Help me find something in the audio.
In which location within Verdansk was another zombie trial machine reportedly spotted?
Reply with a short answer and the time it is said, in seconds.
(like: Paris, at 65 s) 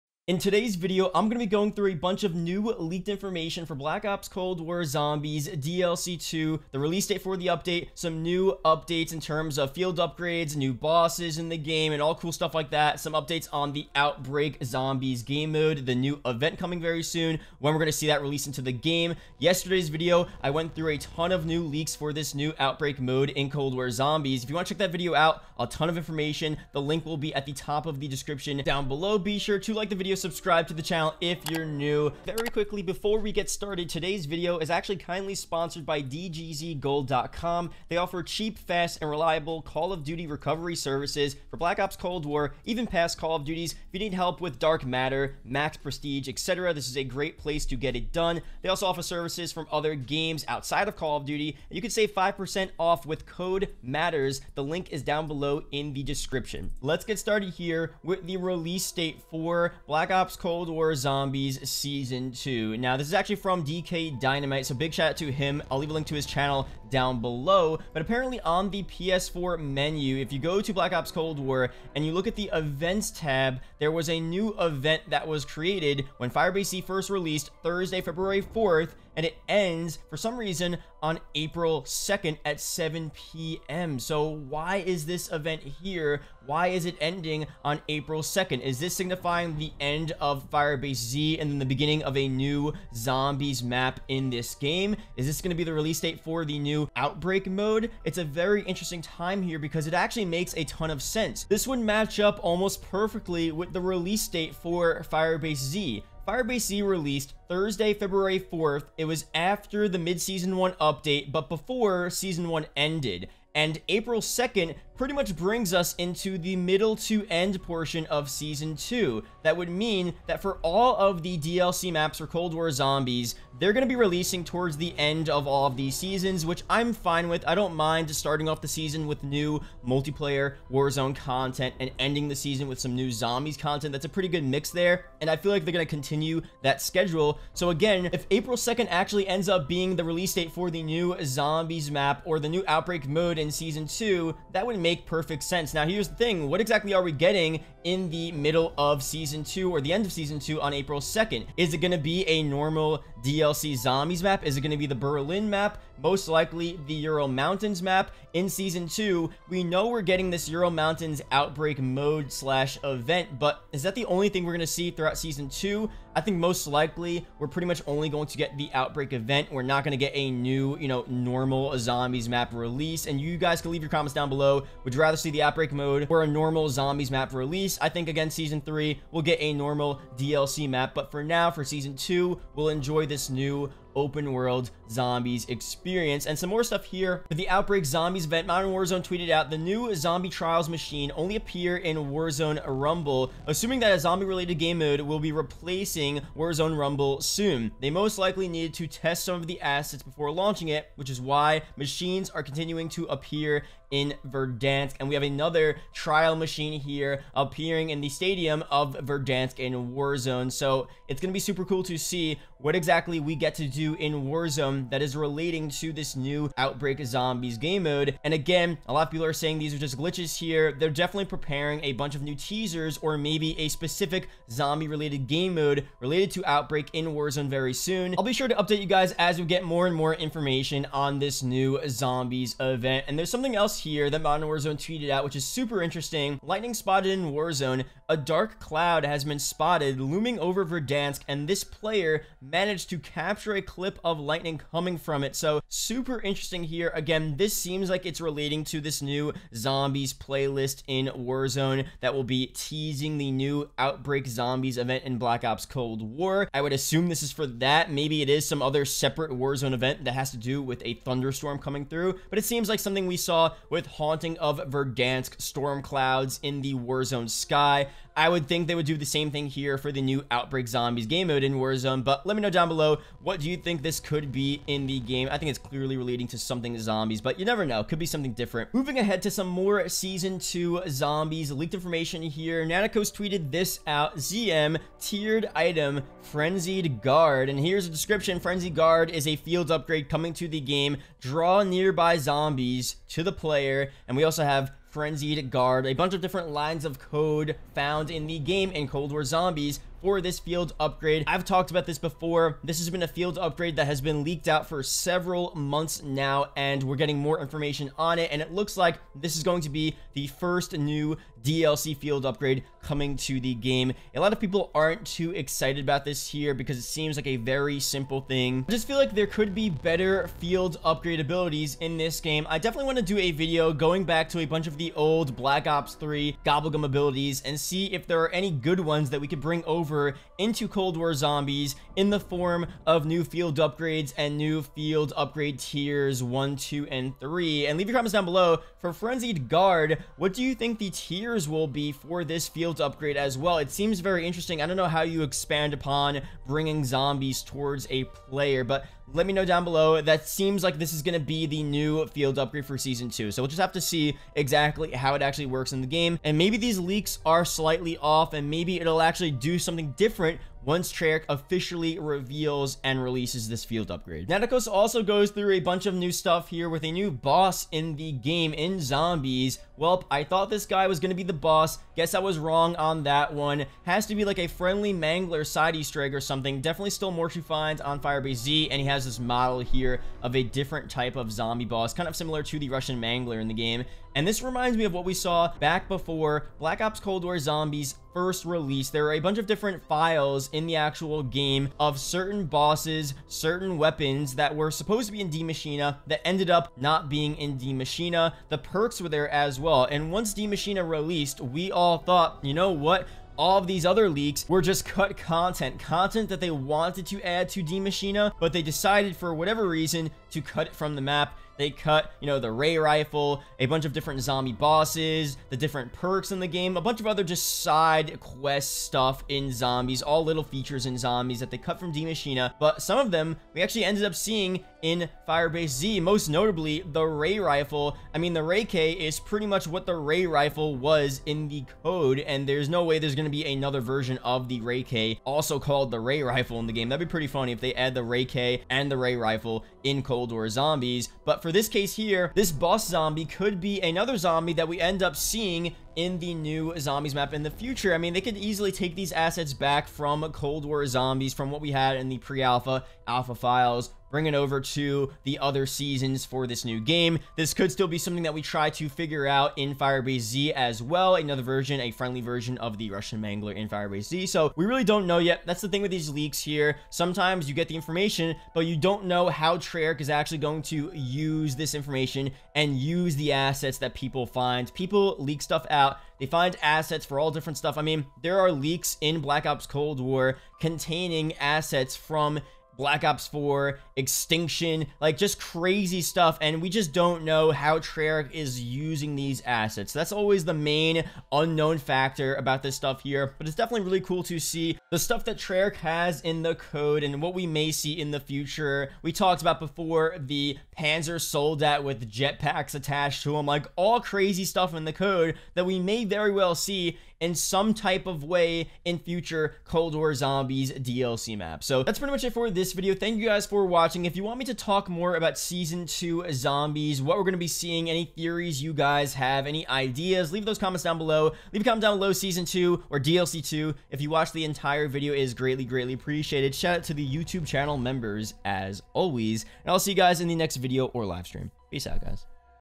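The stadium, at 208 s.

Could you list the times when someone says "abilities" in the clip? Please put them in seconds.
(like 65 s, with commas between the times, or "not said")
321 s, 326 s.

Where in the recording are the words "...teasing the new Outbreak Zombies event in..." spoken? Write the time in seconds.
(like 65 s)
252 s.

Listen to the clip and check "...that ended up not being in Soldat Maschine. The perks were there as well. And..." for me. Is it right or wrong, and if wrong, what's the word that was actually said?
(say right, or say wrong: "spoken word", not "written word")
wrong: "Die", not "Soldat".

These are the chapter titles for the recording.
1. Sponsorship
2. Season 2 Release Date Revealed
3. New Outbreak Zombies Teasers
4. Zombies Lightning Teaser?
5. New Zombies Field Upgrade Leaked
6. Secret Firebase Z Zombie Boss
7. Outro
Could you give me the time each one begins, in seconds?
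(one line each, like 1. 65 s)
1. 32 s
2. 56 s
3. 187 s
4. 233 s
5. 278 s
6. 364 s
7. 511 s.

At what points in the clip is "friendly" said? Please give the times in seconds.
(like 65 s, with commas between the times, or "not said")
374 s, 461 s.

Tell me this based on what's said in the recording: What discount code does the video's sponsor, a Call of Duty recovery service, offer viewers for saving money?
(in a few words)
MATTERZ.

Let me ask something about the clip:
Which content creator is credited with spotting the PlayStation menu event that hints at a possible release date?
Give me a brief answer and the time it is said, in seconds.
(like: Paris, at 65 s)
DK Dynamite, at 63 s.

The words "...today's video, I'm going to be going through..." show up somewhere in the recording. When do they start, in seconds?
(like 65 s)
0 s.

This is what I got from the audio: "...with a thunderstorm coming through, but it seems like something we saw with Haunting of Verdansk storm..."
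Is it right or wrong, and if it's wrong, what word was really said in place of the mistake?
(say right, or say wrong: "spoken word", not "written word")
right.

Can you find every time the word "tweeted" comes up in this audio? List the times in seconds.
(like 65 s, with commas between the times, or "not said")
189 s, 234 s, 283 s.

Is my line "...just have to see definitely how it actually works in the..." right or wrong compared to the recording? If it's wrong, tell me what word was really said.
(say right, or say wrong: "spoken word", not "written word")
wrong: "exactly", not "definitely".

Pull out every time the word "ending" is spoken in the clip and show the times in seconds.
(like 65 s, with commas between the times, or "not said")
87 s, 131 s.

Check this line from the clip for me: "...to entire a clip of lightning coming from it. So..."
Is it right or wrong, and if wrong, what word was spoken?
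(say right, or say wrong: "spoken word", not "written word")
wrong: "capture", not "entire".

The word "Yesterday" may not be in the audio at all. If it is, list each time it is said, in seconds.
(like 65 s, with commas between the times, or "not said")
19 s.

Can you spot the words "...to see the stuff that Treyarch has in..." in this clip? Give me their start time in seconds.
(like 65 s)
494 s.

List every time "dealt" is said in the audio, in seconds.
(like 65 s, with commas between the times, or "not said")
not said.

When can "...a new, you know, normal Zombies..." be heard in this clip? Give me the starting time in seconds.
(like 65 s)
170 s.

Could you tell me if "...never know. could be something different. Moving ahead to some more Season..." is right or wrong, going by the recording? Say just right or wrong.
right.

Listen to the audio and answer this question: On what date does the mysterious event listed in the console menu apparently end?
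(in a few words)
April 2nd.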